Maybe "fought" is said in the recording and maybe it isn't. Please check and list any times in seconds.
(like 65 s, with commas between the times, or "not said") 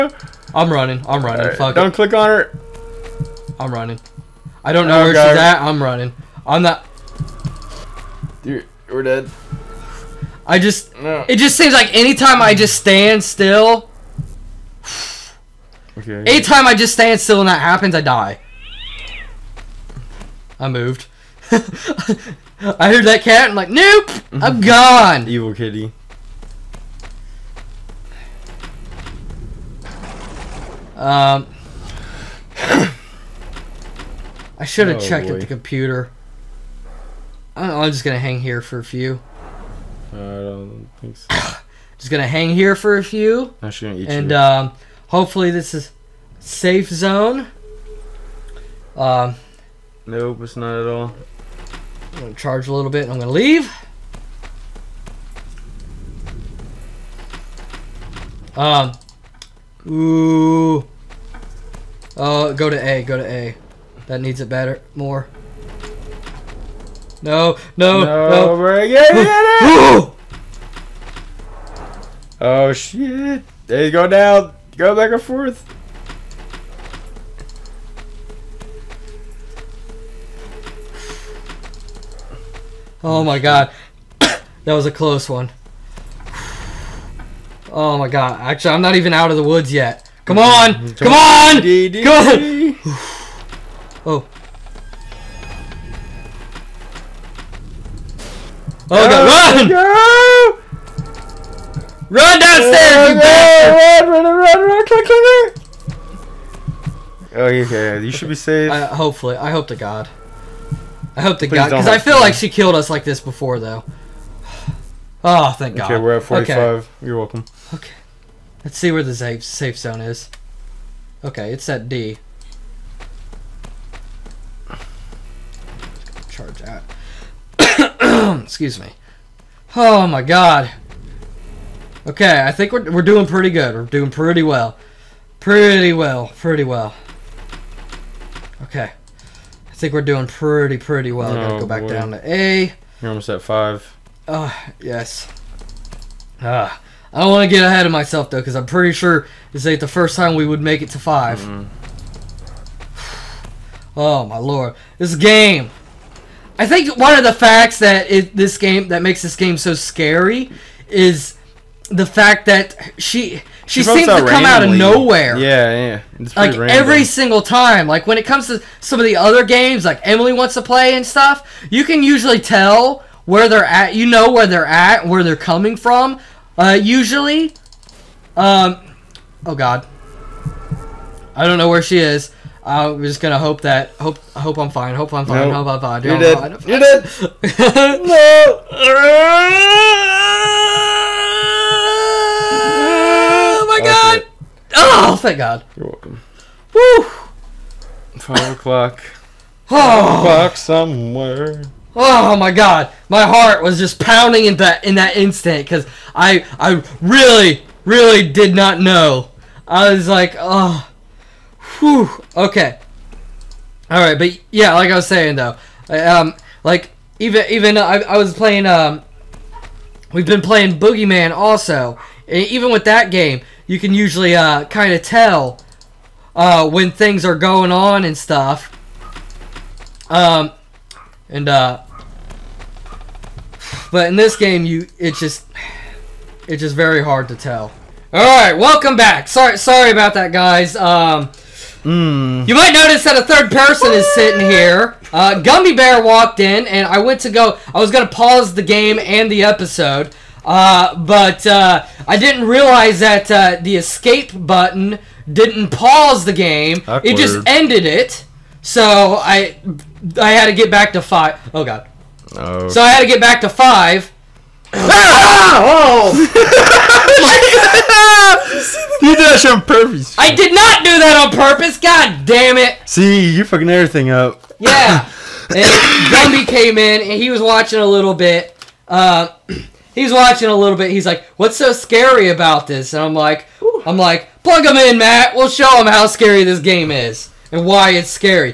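not said.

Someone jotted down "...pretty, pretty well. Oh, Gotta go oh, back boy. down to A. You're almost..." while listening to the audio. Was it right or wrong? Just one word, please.
right.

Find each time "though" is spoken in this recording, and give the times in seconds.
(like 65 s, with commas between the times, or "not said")
113 s, 148 s, 215 s.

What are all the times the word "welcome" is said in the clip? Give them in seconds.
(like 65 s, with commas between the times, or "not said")
117 s, 195 s, 238 s.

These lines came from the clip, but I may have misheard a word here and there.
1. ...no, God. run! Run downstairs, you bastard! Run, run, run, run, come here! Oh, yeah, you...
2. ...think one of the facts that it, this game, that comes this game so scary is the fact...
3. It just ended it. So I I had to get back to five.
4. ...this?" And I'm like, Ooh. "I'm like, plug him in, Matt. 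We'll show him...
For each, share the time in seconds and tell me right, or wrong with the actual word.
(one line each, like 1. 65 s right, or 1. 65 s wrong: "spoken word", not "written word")
1. 98 s right
2. 156 s wrong: "makes", not "comes"
3. 257 s right
4. 282 s right.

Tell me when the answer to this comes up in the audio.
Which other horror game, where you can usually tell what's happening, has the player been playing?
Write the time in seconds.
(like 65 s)
220 s.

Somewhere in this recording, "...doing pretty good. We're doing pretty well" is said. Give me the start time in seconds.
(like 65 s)
133 s.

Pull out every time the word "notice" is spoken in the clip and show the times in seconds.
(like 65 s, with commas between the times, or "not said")
242 s.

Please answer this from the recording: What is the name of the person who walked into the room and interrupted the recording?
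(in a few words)
Gumbybear.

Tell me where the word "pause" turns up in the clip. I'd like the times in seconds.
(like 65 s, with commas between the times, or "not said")
248 s, 255 s.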